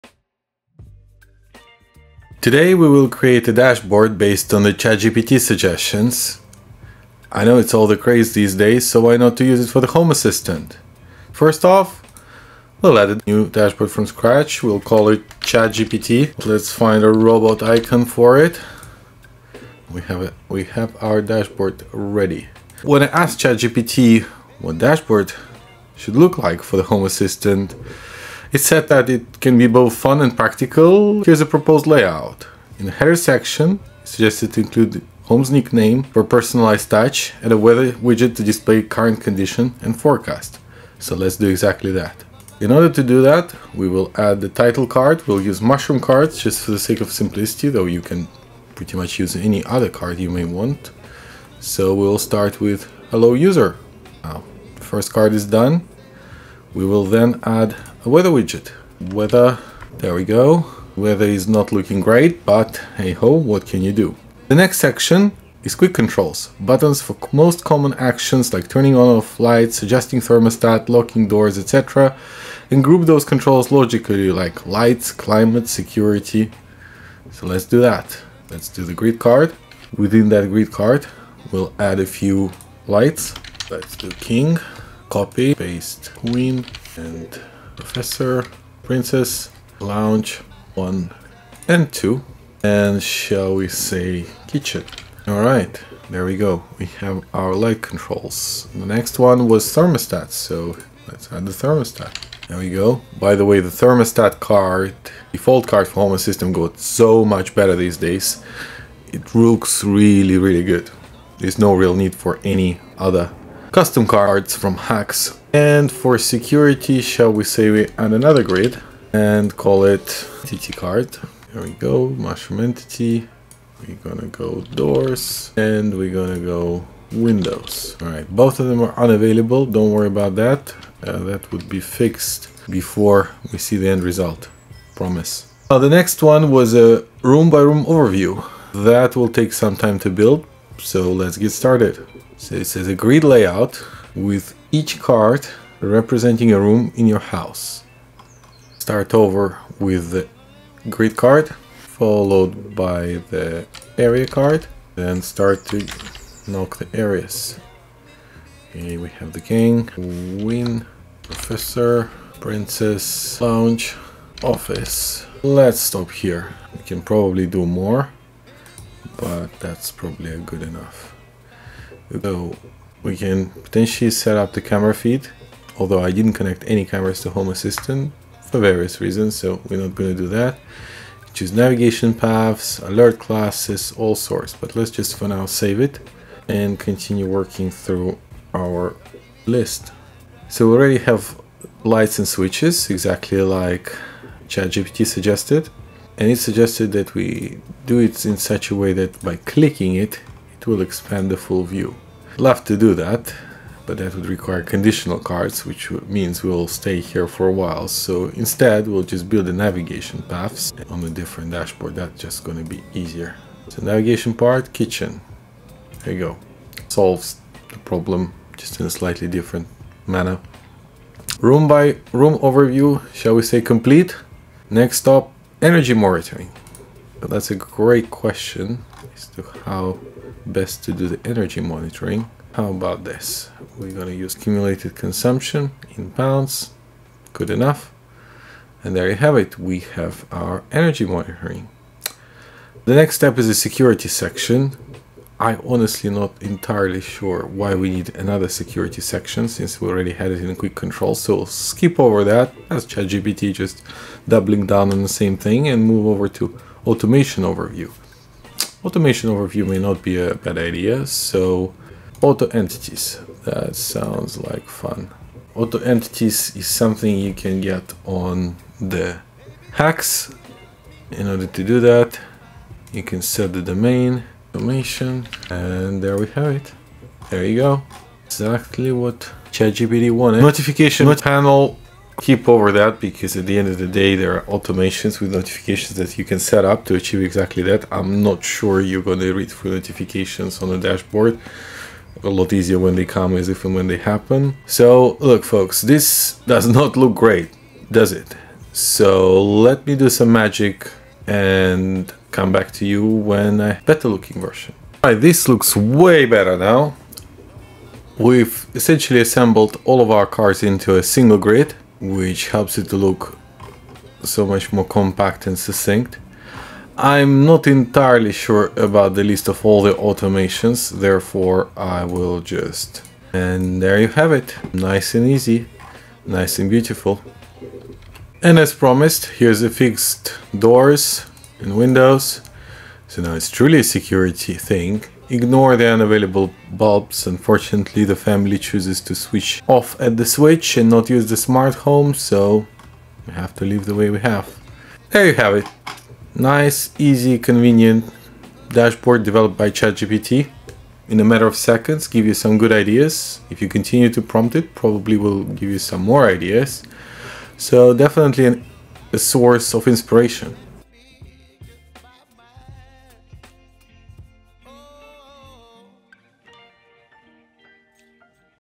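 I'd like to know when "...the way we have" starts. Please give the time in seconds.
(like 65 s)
343 s.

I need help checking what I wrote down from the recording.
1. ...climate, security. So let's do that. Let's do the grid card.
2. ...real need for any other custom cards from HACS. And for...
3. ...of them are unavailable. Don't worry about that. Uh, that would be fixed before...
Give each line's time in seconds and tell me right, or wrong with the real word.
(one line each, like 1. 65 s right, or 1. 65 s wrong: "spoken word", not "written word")
1. 75 s right
2. 111 s right
3. 128 s right.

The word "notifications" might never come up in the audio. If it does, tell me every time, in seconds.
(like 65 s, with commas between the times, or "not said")
280 s, 285 s, 289 s.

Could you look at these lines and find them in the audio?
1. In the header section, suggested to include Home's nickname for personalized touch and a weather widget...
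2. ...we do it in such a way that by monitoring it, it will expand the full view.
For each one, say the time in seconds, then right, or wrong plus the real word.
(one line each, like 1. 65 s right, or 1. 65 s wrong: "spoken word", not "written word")
1. 32 s right
2. 197 s wrong: "clicking", not "monitoring".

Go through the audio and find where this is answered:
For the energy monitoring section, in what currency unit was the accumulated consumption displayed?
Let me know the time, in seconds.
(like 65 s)
236 s.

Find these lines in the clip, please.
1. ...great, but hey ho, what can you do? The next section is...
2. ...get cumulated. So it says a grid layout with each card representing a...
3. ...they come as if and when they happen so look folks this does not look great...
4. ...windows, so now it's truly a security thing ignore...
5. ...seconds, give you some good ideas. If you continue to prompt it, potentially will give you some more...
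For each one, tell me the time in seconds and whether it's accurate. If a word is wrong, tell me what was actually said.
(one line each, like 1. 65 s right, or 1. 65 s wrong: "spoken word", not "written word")
1. 61 s right
2. 141 s wrong: "started", not "cumulated"
3. 292 s right
4. 331 s right
5. 351 s wrong: "probably", not "potentially".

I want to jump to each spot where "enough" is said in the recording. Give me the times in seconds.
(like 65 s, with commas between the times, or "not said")
170 s, 237 s.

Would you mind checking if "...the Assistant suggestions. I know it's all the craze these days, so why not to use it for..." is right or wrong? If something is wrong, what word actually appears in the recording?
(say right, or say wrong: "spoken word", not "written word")
wrong: "ChatGPT", not "Assistant".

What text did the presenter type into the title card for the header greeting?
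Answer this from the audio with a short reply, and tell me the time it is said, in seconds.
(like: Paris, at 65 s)
Hello user, at 53 s.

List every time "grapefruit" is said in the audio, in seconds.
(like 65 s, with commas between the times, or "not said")
not said.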